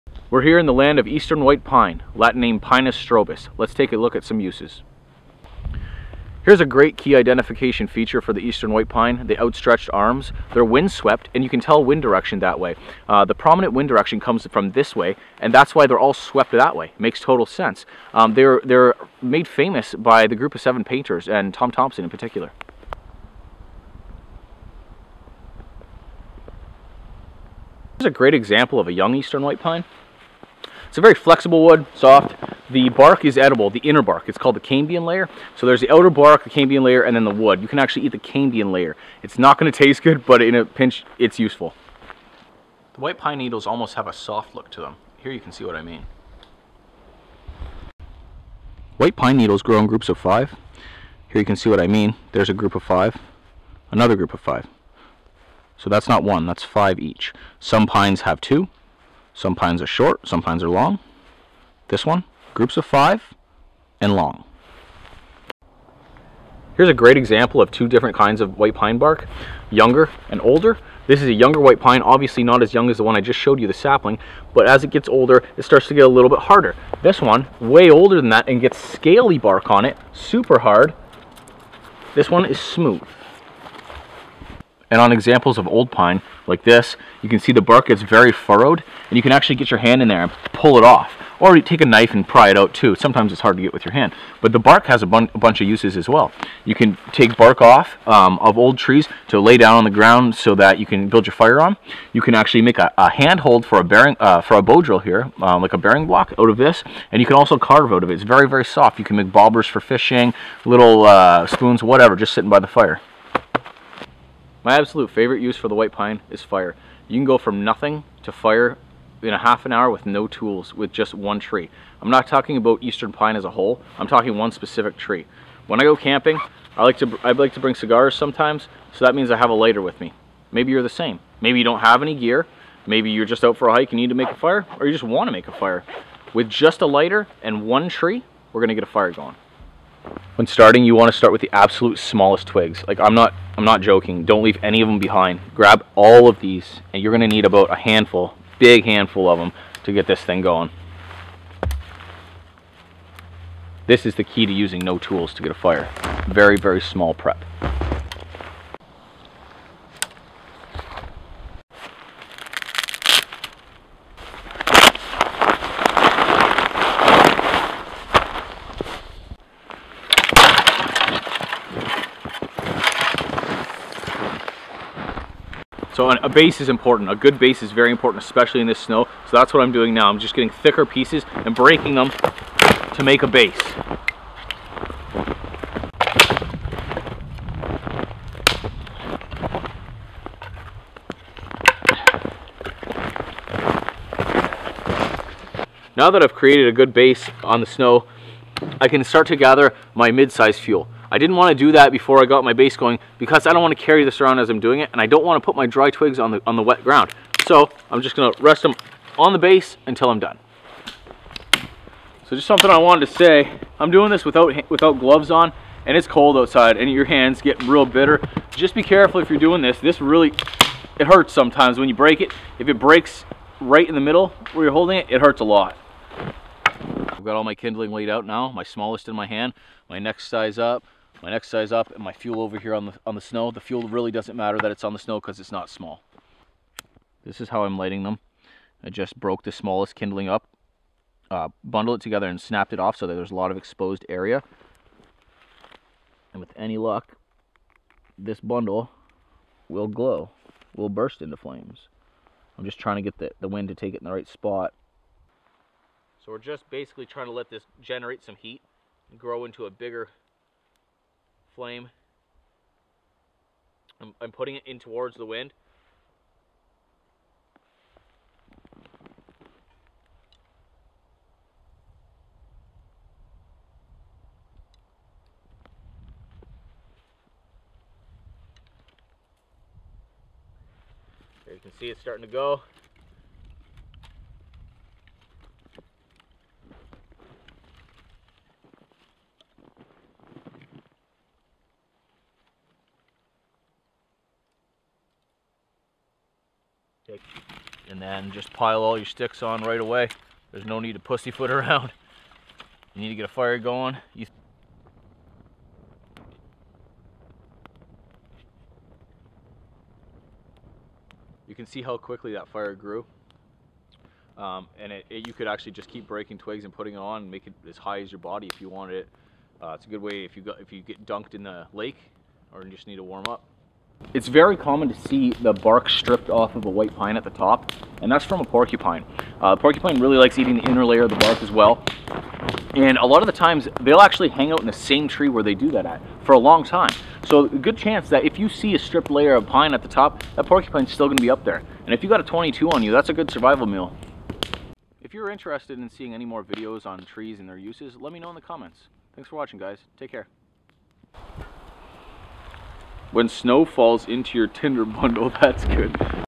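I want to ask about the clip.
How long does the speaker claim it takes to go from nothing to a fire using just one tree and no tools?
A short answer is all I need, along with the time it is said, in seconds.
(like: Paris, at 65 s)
half an hour, at 119 s.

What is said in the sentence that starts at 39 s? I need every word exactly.
It's not gonna taste good, but in a pinch, it's useful.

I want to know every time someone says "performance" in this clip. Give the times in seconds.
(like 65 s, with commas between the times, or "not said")
not said.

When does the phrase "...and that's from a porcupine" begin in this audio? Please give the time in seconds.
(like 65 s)
328 s.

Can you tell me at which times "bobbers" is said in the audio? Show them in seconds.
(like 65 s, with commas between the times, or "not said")
109 s.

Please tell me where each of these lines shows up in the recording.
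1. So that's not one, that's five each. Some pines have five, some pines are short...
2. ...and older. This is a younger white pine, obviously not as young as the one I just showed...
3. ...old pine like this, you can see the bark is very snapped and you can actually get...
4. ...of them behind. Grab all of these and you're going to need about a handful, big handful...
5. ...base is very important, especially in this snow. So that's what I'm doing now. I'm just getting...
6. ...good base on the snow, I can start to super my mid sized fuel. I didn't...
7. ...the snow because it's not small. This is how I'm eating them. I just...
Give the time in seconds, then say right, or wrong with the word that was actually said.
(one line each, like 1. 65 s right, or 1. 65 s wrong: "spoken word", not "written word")
1. 55 s wrong: "two", not "five"
2. 70 s right
3. 85 s wrong: "furrowed", not "snapped"
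4. 144 s right
5. 177 s right
6. 196 s wrong: "gather", not "super"
7. 234 s wrong: "lighting", not "eating".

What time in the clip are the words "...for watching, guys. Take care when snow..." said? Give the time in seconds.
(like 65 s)
349 s.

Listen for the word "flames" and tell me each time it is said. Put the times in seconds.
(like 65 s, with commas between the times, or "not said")
251 s, 261 s.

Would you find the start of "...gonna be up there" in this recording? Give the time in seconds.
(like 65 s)
341 s.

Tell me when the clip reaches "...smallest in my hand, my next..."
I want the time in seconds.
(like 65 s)
228 s.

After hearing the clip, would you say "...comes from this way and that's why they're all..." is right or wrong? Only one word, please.
right.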